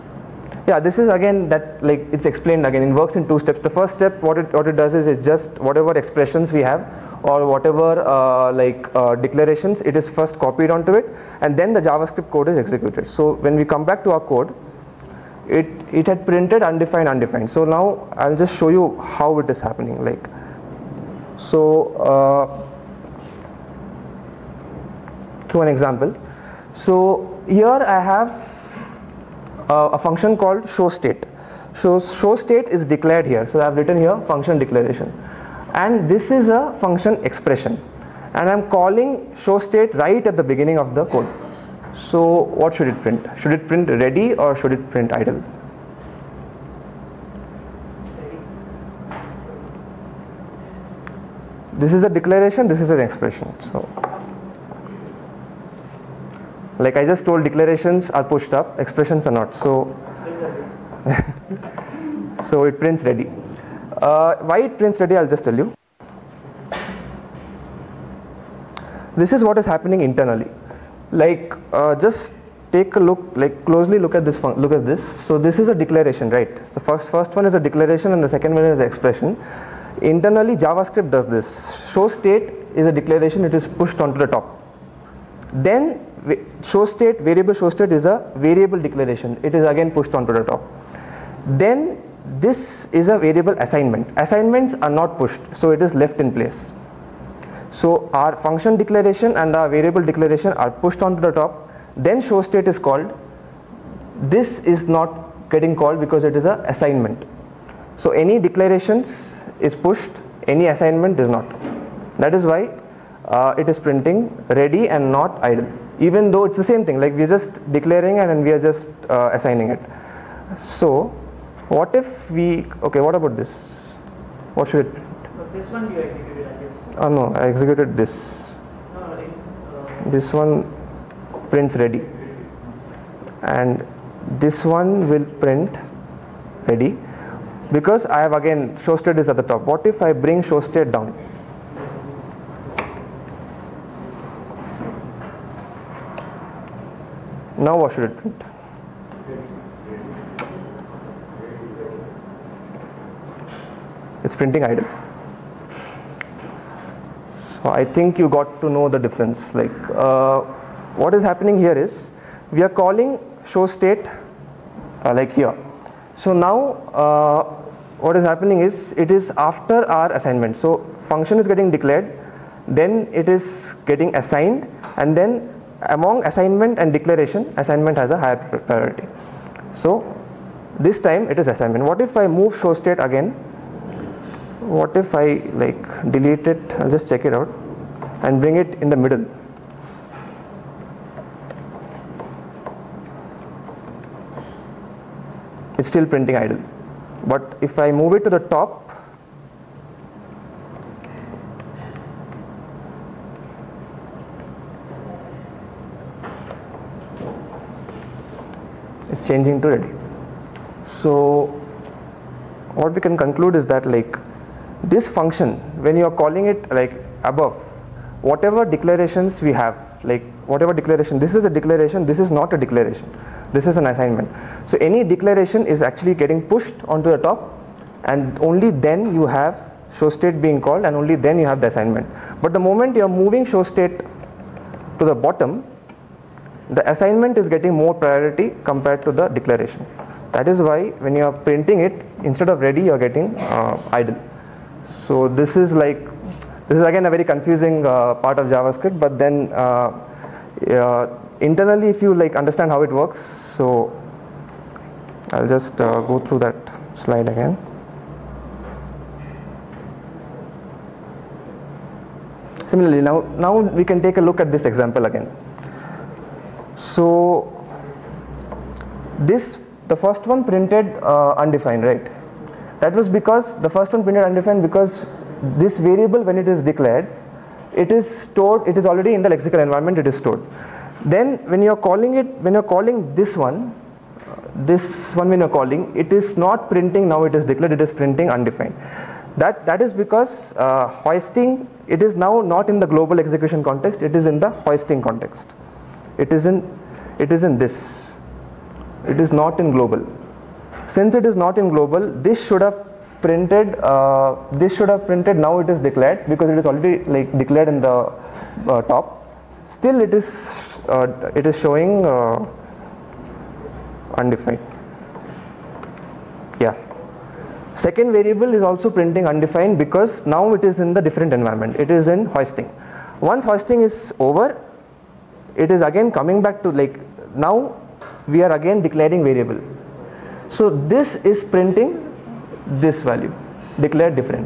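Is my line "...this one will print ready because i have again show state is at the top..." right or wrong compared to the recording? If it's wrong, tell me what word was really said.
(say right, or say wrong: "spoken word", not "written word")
right.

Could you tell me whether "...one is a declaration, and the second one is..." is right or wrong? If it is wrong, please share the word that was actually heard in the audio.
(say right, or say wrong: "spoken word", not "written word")
right.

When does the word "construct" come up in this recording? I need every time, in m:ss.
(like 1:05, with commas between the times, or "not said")
not said.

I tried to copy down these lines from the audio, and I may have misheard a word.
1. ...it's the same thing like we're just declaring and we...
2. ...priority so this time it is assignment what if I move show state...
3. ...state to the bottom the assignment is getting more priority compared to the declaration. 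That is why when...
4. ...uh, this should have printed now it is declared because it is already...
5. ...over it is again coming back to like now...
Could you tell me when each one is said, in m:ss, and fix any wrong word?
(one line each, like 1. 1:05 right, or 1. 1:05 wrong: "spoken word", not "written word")
1. 1:56 right
2. 2:58 right
3. 3:53 right
4. 5:03 right
5. 5:24 right.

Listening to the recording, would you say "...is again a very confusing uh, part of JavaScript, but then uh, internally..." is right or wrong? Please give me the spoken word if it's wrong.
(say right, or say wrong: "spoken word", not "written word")
right.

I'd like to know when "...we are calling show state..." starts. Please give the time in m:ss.
2:42.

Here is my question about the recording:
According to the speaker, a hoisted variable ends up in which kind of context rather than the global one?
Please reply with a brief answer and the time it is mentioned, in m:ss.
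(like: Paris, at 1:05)
hoisting context, at 4:54.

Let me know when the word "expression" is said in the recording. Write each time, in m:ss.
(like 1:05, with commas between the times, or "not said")
0:05, 0:37, 0:52, 0:58, 1:18.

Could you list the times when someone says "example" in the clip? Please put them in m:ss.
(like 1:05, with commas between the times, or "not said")
0:25, 4:24.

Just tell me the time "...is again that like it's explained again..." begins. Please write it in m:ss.
0:00.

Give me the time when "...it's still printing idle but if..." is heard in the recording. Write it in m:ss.
3:15.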